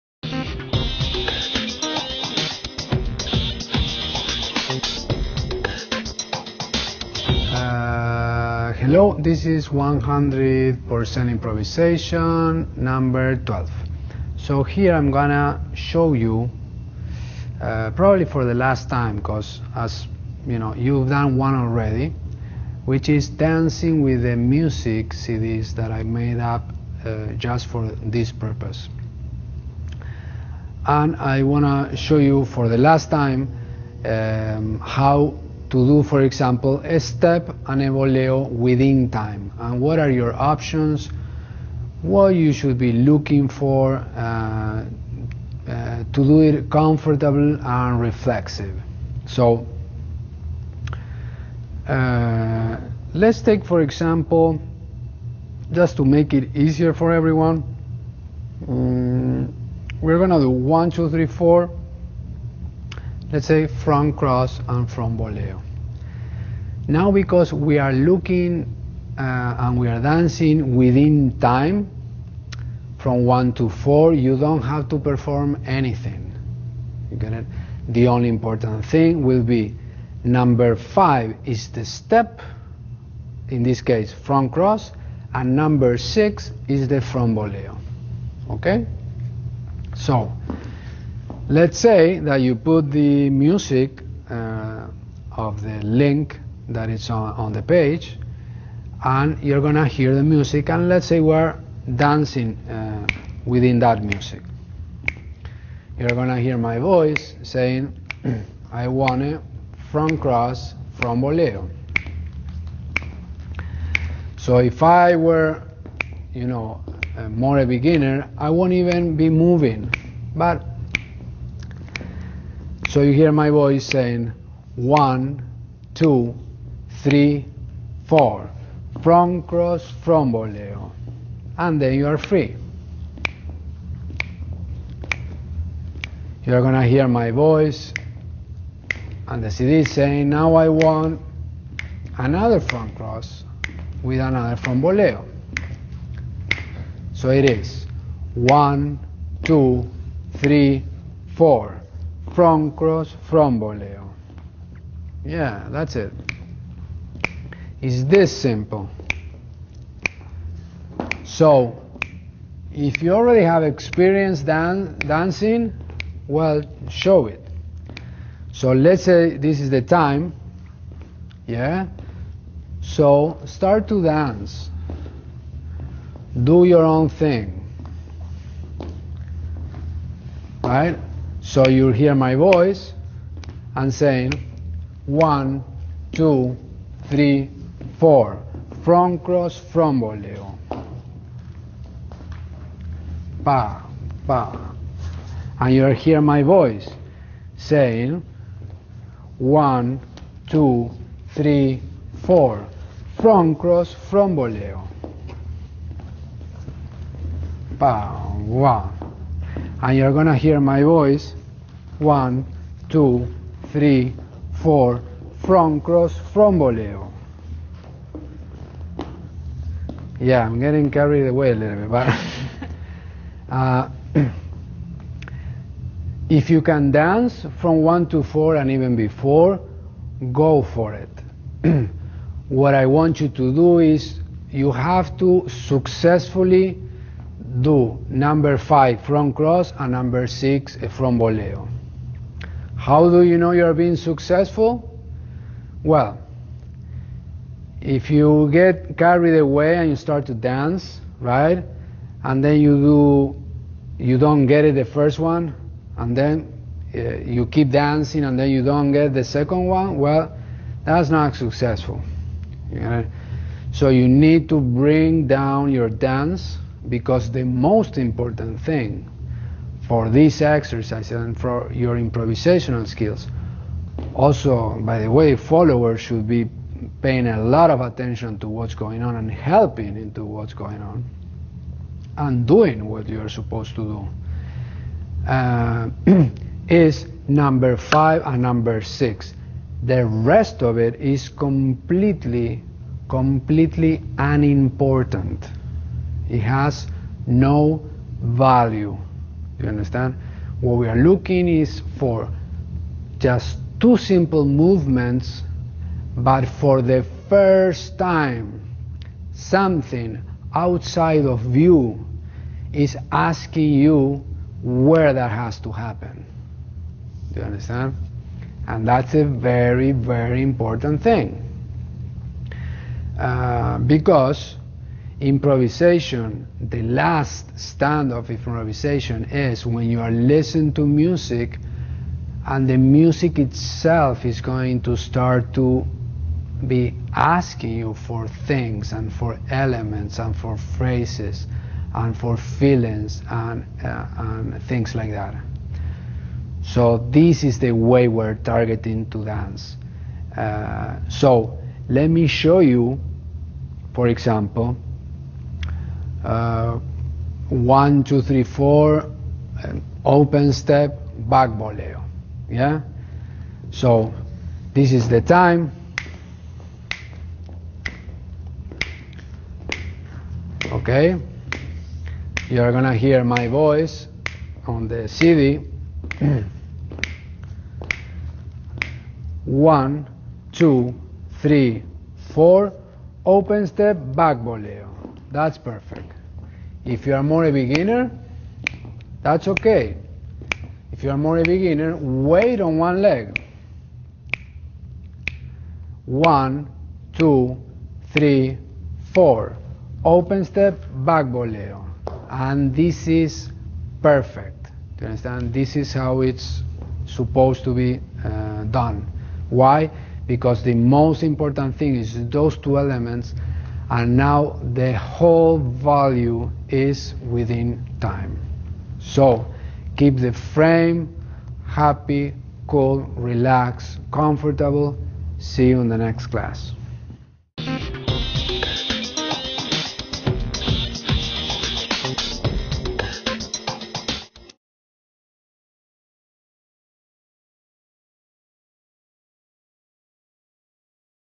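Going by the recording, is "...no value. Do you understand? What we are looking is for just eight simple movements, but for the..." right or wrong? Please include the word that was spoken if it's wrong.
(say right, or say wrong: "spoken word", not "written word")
wrong: "two", not "eight".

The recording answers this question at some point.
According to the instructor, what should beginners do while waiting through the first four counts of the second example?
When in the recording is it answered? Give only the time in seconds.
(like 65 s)
391 s.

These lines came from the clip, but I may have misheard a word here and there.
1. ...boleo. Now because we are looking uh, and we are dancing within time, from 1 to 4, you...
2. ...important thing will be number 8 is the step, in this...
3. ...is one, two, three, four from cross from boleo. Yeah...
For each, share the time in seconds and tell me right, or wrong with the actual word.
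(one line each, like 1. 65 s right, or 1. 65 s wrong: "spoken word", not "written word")
1. 65 s right
2. 78 s wrong: "5", not "8"
3. 147 s right.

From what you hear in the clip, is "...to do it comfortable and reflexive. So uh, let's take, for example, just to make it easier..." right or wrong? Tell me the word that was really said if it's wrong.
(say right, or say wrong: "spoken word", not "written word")
right.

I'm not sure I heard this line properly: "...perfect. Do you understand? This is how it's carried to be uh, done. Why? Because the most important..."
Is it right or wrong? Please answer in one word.
wrong.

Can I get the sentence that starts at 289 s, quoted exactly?
The rest of it is completely, completely unimportant.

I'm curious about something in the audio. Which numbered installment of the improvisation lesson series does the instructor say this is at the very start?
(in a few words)
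12.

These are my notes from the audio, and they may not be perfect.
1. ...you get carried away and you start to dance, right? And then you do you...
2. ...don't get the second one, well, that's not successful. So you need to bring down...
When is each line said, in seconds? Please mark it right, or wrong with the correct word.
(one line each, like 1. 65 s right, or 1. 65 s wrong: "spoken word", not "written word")
1. 248 s right
2. 258 s right.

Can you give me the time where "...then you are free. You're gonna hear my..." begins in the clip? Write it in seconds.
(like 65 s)
131 s.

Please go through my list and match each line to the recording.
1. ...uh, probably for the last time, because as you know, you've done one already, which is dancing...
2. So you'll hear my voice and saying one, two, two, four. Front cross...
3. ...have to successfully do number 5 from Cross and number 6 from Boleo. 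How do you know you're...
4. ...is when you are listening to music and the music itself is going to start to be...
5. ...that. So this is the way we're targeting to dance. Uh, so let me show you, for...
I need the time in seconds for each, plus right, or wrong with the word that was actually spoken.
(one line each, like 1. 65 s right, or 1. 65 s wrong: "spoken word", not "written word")
1. 17 s right
2. 181 s wrong: "three", not "two"
3. 234 s right
4. 329 s right
5. 345 s right.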